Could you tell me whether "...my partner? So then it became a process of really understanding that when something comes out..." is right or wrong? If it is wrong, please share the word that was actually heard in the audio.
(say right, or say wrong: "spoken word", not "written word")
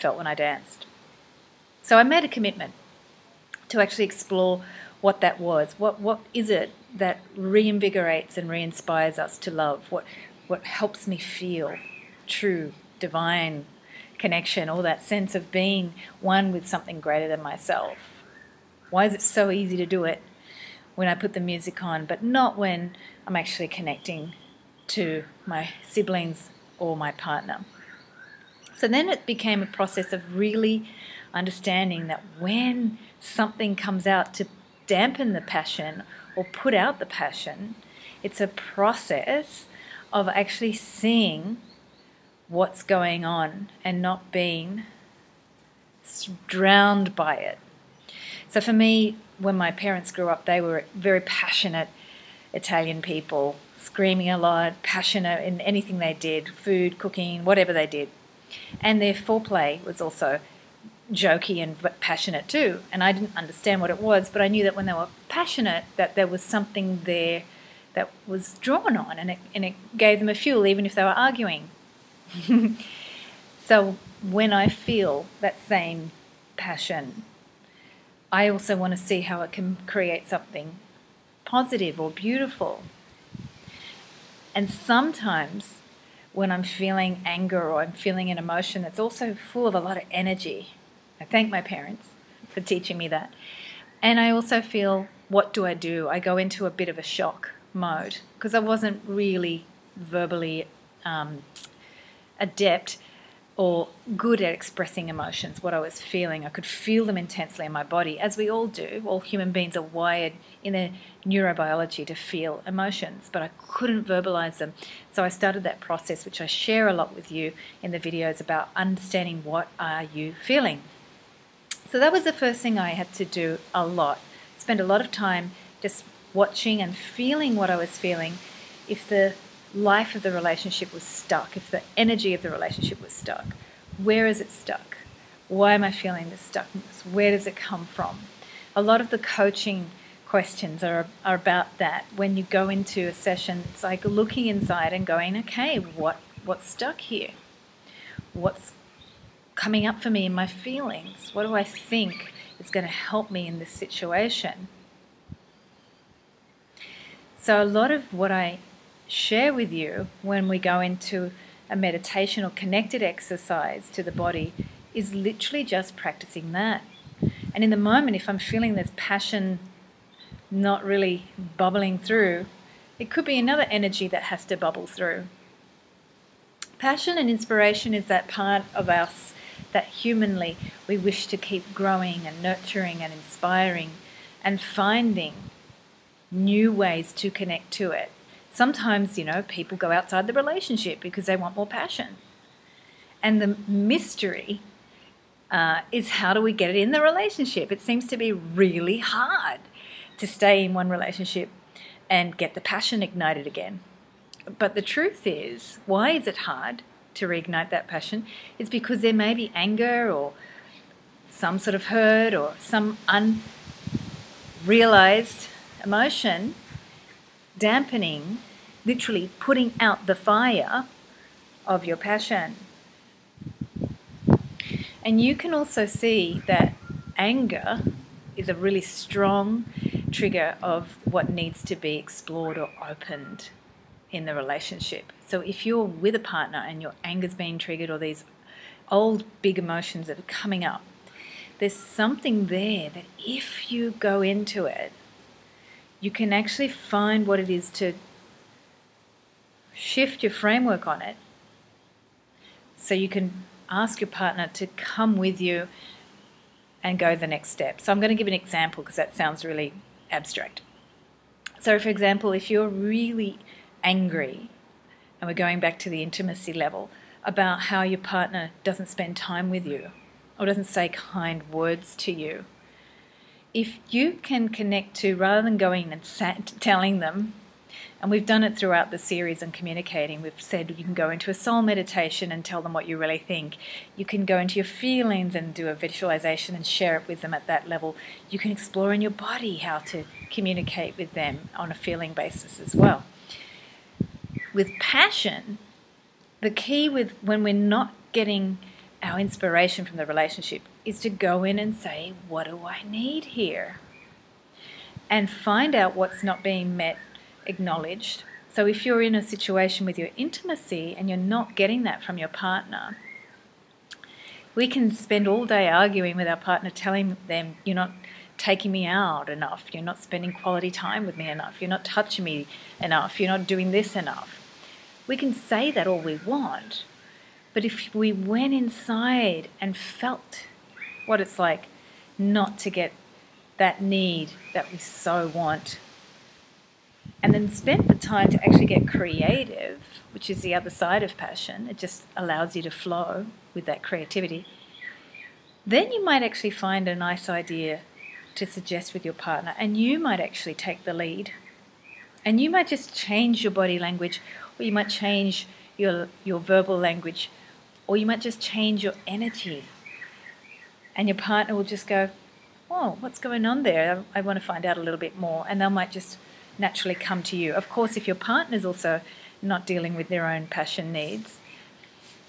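right.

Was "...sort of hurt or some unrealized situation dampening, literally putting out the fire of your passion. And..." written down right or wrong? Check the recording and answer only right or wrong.
wrong.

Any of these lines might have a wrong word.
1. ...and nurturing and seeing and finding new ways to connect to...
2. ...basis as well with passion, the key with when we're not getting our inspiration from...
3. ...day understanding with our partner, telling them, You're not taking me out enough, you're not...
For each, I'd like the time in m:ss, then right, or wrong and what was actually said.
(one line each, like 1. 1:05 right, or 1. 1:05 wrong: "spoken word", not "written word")
1. 3:02 wrong: "inspiring", not "seeing"
2. 4:52 right
3. 5:15 wrong: "arguing", not "understanding".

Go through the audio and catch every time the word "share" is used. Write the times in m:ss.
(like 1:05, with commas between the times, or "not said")
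1:56, 2:39, 4:46.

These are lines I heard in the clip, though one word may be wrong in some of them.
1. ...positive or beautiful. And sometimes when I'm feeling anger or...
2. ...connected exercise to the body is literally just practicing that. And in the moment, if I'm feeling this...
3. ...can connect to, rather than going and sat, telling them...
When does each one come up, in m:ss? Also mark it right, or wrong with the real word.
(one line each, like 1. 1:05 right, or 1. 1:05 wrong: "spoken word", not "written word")
1. 1:21 right
2. 2:42 right
3. 4:34 right.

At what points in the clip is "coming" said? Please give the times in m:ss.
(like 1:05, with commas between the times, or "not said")
2:29, 4:00.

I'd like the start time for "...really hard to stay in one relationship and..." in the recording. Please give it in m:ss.
3:18.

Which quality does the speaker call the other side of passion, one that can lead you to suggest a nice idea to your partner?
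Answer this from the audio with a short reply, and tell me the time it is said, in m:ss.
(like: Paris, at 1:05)
creative, at 5:38.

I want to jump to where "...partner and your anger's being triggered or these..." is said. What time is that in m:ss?
3:56.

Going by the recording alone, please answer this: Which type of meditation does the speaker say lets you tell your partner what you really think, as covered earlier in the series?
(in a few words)
soul meditation.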